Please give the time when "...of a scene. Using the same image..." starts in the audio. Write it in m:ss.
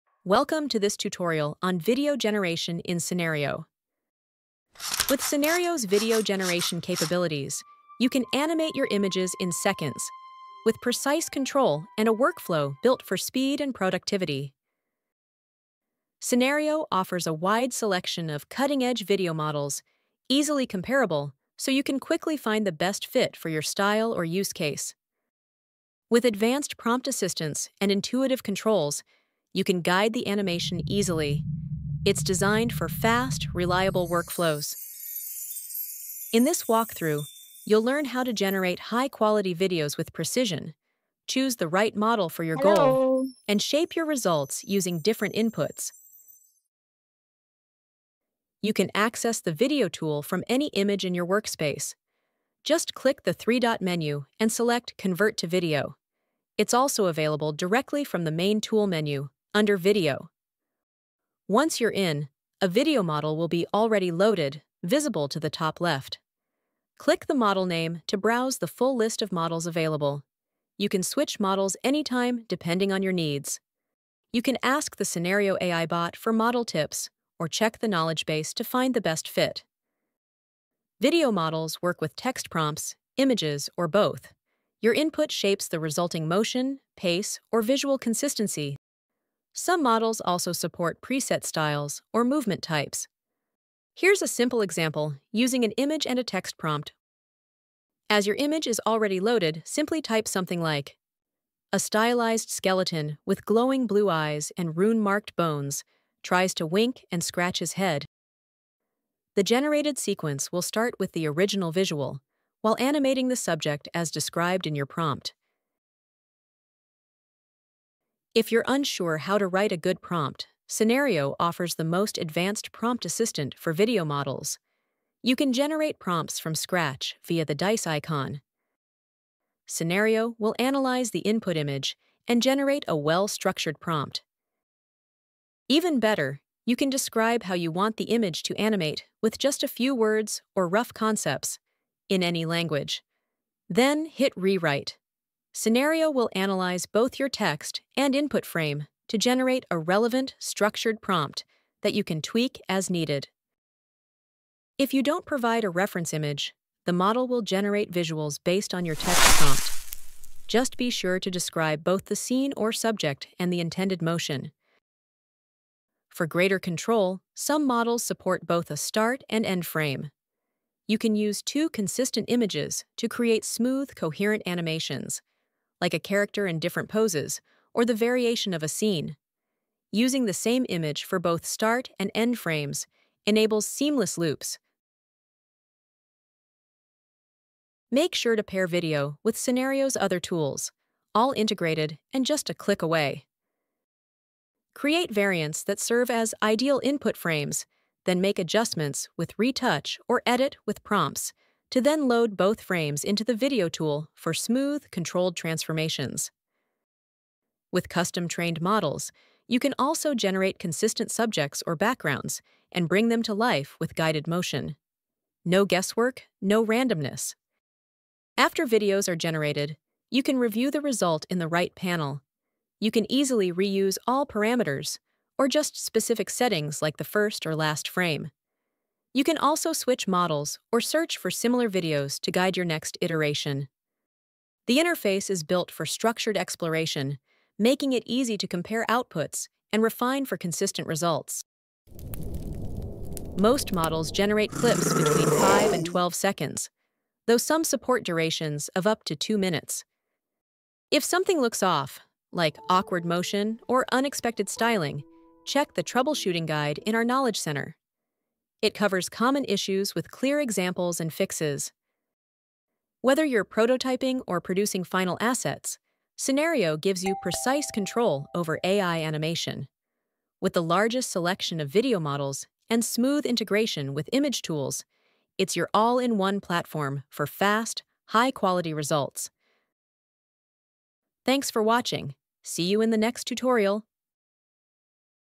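2:58.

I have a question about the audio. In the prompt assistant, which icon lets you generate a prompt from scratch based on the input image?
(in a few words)
dice icon.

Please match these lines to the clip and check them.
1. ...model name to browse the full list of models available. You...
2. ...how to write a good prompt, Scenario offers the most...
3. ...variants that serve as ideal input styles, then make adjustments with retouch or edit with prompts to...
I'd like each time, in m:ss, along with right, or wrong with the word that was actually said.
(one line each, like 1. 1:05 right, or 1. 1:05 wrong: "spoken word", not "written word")
1. 1:07 right
2. 1:59 right
3. 3:15 wrong: "frames", not "styles".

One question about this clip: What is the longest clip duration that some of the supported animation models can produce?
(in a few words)
2 minutes.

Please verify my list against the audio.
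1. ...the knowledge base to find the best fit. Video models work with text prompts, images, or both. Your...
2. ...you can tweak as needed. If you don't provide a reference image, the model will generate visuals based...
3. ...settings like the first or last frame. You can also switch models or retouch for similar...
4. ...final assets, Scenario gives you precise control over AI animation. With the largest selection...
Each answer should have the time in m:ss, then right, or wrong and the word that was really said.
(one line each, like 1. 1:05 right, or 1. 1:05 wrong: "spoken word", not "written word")
1. 1:17 right
2. 2:31 right
3. 3:46 wrong: "search", not "retouch"
4. 4:24 right.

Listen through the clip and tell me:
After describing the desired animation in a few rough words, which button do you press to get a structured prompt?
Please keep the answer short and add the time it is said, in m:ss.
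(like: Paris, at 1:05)
Rewrite, at 2:24.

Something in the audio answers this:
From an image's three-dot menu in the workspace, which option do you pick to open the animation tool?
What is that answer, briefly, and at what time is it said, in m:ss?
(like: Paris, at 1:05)
Convert to Video, at 0:54.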